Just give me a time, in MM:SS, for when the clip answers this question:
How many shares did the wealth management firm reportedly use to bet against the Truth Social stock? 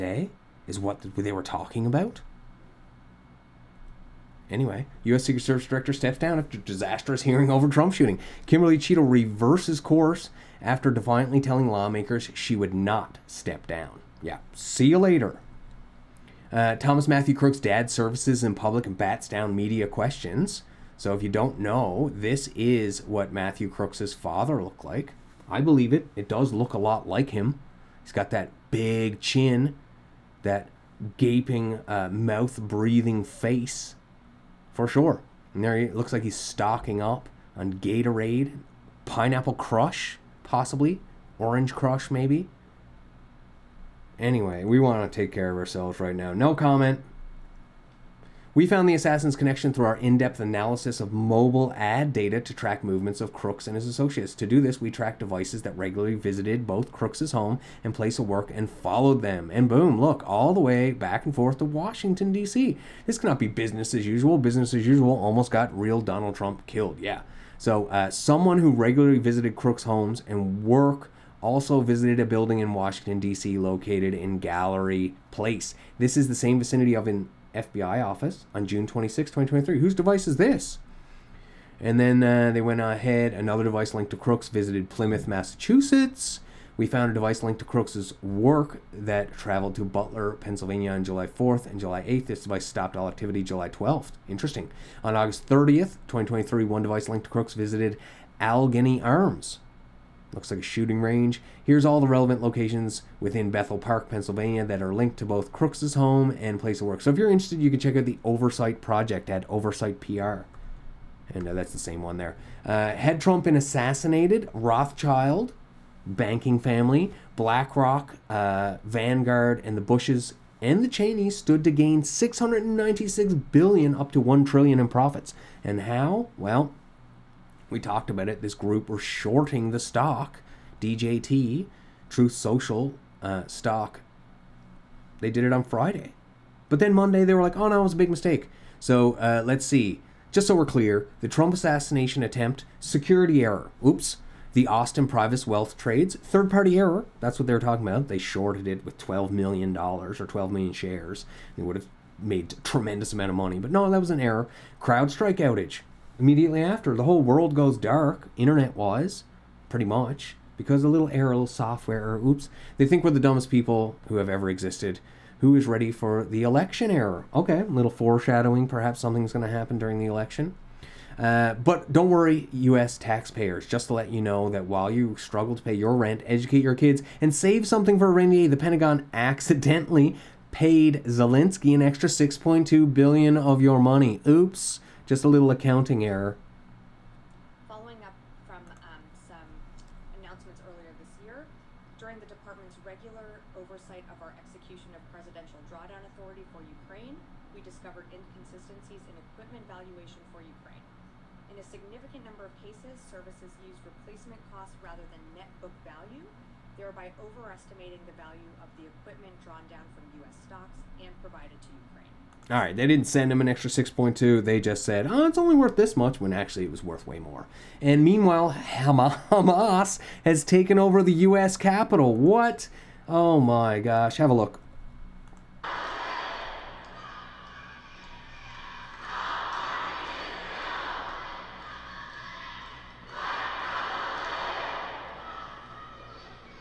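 02:30.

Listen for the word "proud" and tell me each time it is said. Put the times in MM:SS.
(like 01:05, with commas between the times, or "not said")
not said.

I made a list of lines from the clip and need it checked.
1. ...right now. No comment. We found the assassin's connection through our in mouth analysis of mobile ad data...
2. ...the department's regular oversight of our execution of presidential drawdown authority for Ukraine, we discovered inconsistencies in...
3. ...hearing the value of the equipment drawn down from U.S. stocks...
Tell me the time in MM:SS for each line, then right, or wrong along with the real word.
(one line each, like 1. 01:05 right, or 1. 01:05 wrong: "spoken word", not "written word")
1. 00:45 wrong: "depth", not "mouth"
2. 03:12 right
3. 03:27 wrong: "overestimating", not "hearing".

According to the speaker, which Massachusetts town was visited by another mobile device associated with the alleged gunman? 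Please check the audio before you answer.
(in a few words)
Plymouth.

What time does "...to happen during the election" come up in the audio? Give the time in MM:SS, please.
02:49.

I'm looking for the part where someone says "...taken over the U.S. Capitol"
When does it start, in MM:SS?
03:40.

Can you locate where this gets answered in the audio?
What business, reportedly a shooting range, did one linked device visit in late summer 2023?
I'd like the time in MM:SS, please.
01:38.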